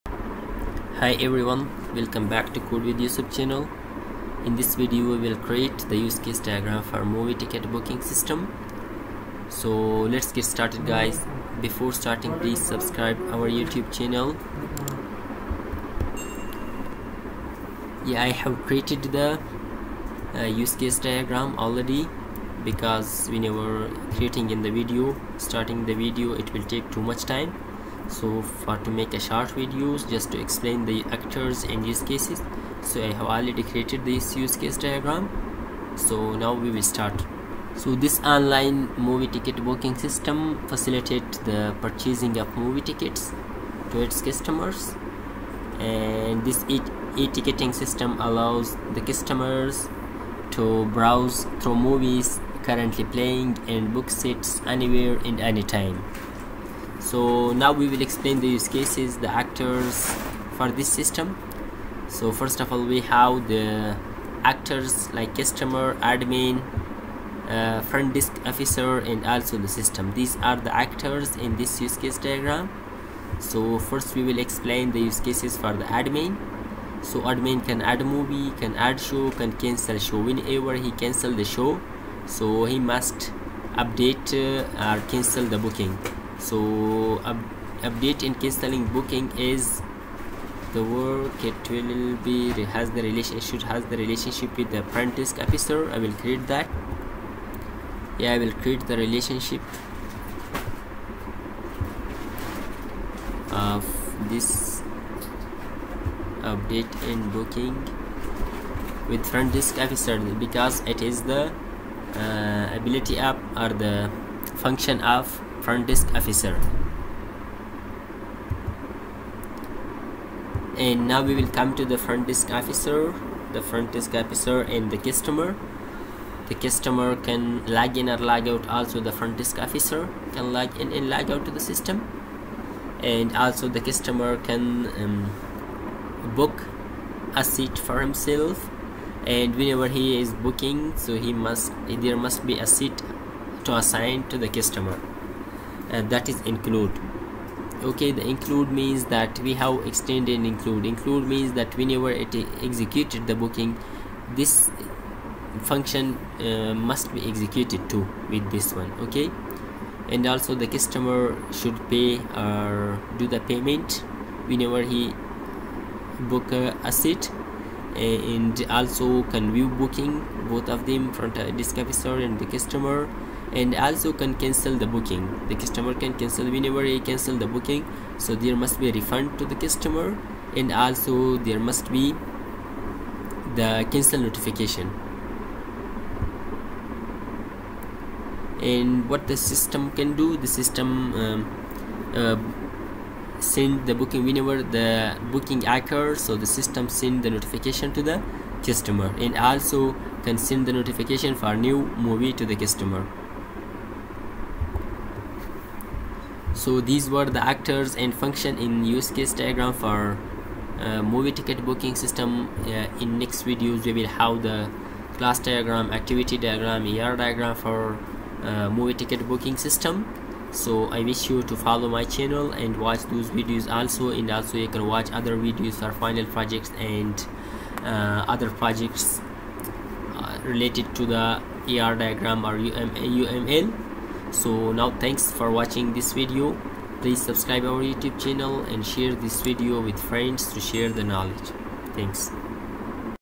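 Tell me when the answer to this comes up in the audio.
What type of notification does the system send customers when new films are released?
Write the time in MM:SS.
03:21.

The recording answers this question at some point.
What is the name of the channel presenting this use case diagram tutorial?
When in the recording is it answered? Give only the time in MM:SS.
00:02.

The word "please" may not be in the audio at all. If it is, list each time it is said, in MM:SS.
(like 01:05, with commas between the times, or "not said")
00:12, 03:57.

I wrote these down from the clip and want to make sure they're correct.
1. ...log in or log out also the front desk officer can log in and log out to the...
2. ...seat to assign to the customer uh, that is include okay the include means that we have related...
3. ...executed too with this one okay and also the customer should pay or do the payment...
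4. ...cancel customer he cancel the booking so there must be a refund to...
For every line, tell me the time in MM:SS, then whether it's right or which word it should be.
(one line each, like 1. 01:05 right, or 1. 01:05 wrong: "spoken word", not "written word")
1. 02:07 right
2. 02:22 wrong: "extended", not "related"
3. 02:37 right
4. 02:56 wrong: "whenever", not "customer".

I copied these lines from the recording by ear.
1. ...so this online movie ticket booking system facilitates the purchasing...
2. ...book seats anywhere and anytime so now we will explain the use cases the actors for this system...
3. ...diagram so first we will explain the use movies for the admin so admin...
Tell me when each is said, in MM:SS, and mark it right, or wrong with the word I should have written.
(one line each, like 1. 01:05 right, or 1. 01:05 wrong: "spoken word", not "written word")
1. 00:37 right
2. 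00:53 right
3. 01:12 wrong: "cases", not "movies".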